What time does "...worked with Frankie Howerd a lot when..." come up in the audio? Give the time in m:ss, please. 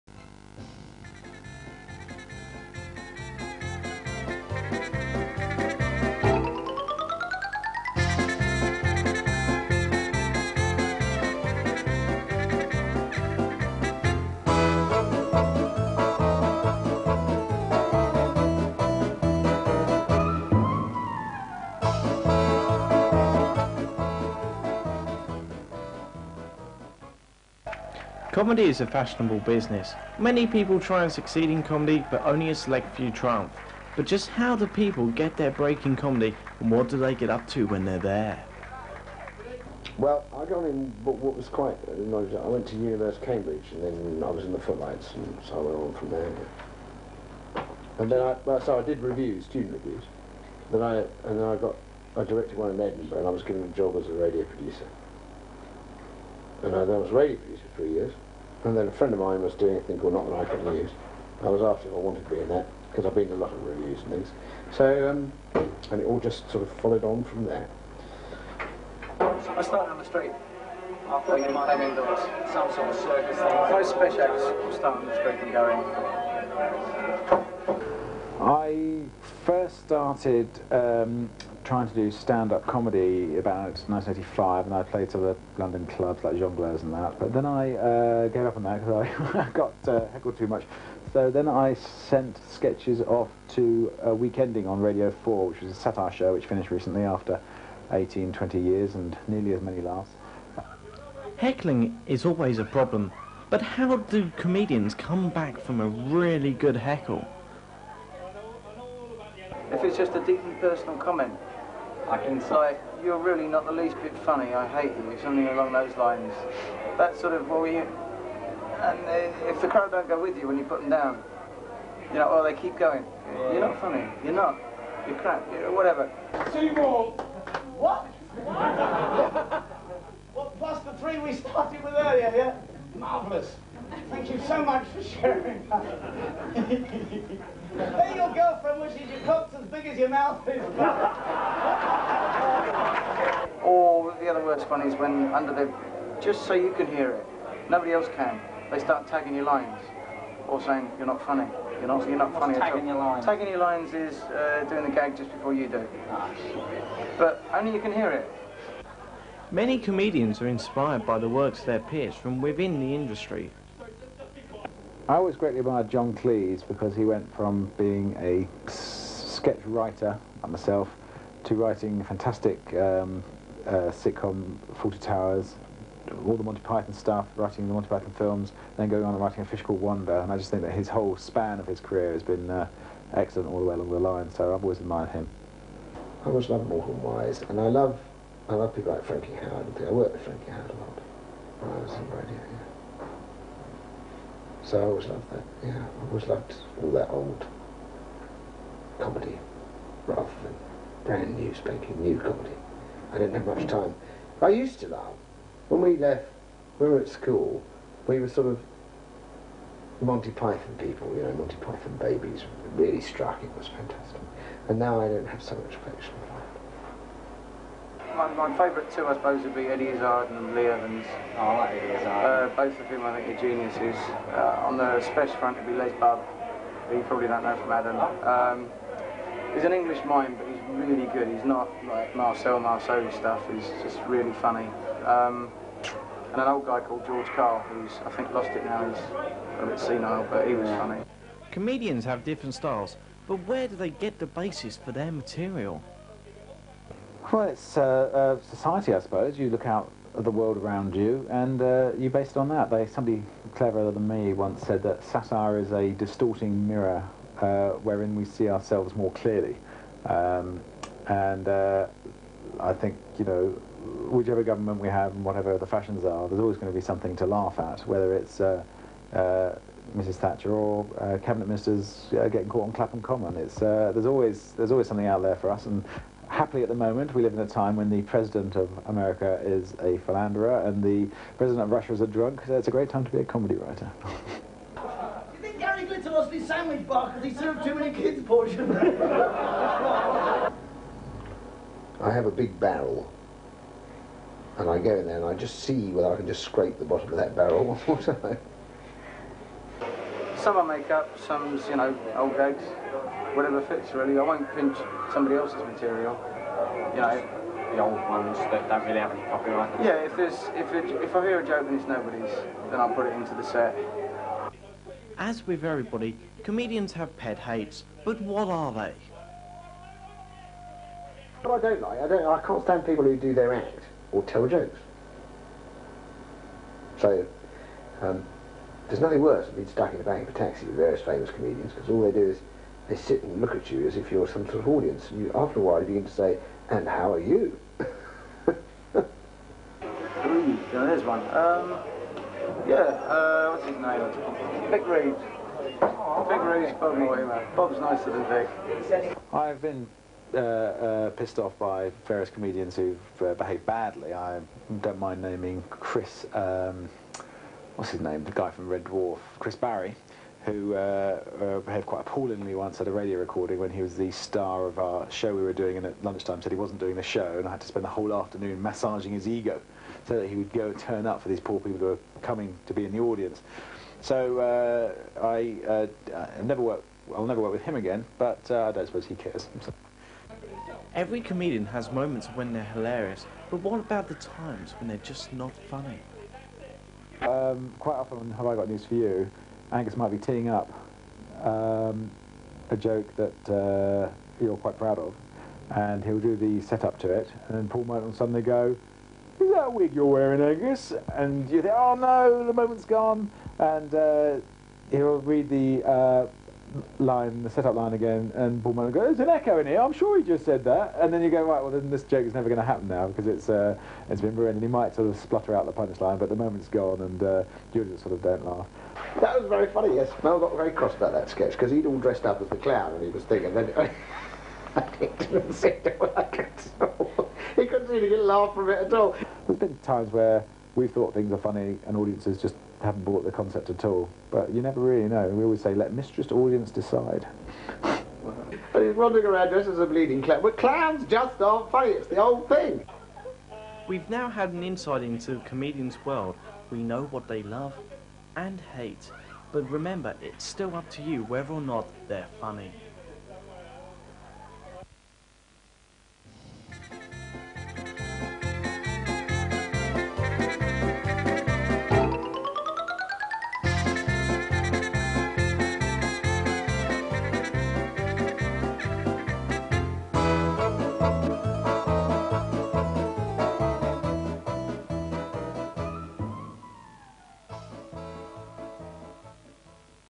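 3:09.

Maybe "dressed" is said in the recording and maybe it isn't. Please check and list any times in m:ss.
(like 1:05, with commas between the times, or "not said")
7:01, 7:19.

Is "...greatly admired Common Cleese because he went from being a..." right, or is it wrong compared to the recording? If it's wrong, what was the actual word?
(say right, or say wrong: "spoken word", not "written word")
wrong: "John", not "Common".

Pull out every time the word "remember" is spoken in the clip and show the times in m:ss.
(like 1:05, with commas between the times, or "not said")
7:29.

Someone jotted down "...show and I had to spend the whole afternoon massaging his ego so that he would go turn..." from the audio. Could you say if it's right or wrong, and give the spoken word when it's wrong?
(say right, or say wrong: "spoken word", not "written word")
right.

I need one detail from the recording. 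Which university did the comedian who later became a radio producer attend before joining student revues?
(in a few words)
University of Cambridge.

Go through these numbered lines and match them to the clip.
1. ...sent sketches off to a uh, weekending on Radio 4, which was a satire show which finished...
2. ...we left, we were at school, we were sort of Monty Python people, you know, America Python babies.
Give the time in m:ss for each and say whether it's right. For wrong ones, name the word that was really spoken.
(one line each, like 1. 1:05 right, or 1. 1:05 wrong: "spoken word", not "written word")
1. 1:31 right
2. 3:25 wrong: "Monty", not "America".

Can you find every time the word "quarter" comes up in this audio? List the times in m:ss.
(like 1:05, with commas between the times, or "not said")
not said.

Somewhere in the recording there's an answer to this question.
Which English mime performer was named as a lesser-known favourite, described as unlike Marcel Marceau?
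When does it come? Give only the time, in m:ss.
3:45.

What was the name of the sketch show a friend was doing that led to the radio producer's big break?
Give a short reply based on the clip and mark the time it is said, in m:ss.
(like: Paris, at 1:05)
Not the Nine O'Clock News, at 1:00.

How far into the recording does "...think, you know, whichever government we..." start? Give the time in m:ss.
4:22.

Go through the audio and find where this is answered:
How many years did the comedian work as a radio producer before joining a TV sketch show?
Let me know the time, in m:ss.
0:57.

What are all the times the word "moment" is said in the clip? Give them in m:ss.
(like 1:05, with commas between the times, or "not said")
4:36, 6:21, 6:42, 6:56.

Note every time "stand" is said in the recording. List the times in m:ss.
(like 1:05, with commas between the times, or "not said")
1:22, 5:22.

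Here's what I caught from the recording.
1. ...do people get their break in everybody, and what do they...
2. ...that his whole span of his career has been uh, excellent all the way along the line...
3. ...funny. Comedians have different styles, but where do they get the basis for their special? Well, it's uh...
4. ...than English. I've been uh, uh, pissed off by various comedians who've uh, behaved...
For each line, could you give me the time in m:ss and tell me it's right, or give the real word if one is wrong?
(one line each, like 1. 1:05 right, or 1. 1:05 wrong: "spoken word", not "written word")
1. 0:34 wrong: "comedy", not "everybody"
2. 3:00 right
3. 4:00 wrong: "material", not "special"
4. 5:48 wrong: "Vic", not "English".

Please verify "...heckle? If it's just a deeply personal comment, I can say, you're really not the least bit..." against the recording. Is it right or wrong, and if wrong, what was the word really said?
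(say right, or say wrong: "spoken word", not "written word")
right.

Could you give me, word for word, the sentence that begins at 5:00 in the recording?
Some I make up, some's, you know, old gags.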